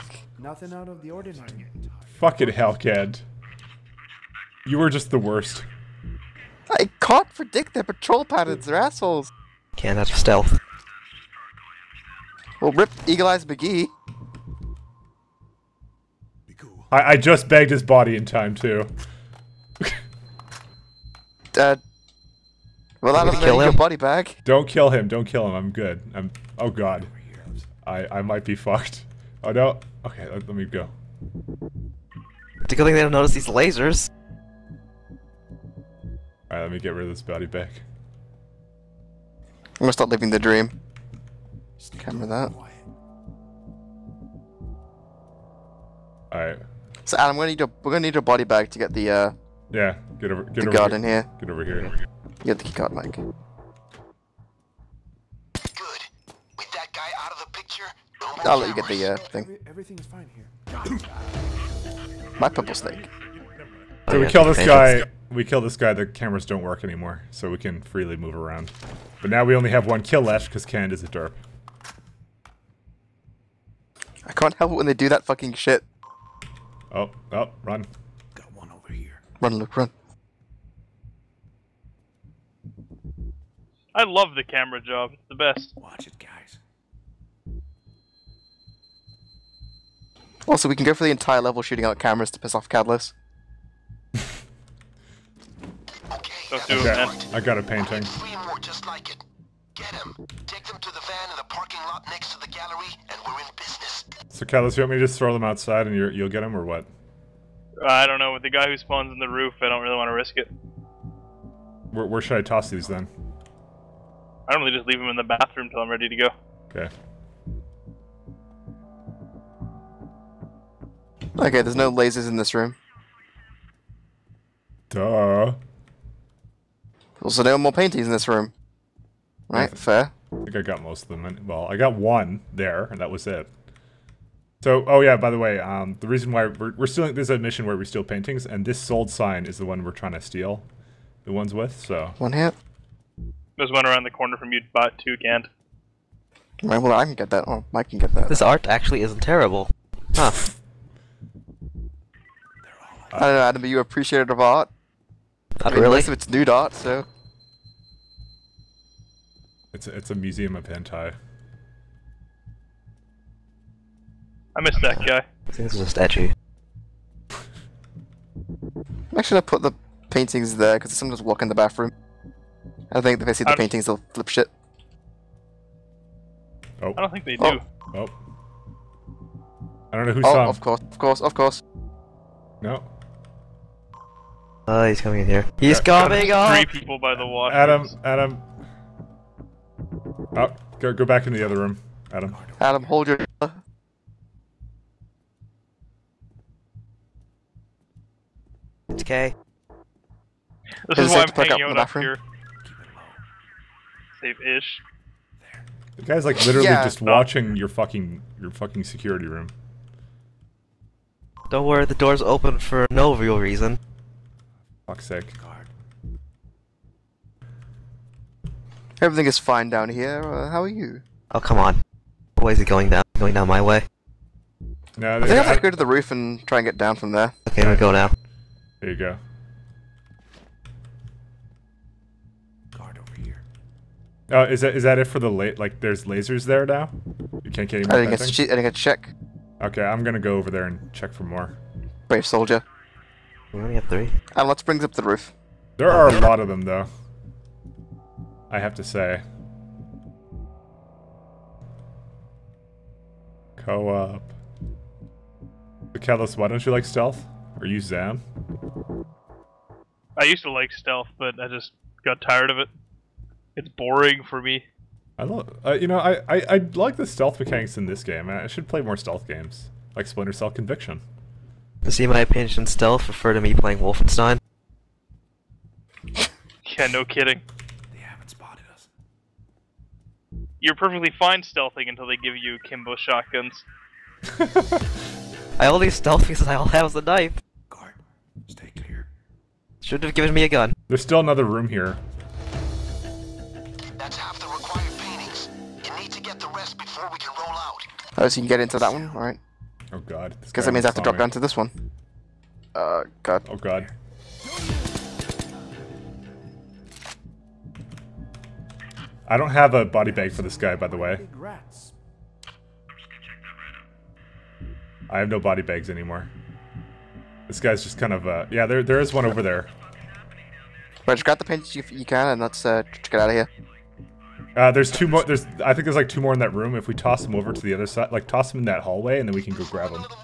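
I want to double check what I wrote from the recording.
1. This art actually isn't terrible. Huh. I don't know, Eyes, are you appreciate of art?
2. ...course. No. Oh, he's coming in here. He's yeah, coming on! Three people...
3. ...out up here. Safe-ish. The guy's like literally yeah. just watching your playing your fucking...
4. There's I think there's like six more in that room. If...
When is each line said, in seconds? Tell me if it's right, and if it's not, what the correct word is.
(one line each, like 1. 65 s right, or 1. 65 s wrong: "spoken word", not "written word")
1. 148 s wrong: "Adam", not "Eyes"
2. 181 s right
3. 201 s wrong: "fucking", not "playing"
4. 325 s wrong: "two", not "six".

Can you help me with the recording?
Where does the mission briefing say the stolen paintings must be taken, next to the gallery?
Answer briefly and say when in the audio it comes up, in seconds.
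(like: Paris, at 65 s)
The van in the parking lot, at 100 s.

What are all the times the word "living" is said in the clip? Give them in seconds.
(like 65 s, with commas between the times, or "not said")
40 s.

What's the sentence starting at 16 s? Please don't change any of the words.
I, I just bagged his body in time, too.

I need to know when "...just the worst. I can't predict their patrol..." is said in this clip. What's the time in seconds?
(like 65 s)
4 s.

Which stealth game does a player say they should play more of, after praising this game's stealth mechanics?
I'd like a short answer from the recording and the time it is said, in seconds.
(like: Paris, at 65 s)
Splinter Cell Conviction, at 270 s.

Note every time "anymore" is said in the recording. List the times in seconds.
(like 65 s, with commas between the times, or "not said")
66 s, 315 s.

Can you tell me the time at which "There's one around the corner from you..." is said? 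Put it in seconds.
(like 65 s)
143 s.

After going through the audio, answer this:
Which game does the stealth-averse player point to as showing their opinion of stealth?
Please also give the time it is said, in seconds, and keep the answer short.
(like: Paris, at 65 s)
Wolfenstein, at 273 s.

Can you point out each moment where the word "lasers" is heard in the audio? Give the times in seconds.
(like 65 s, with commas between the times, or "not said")
33 s, 121 s, 236 s.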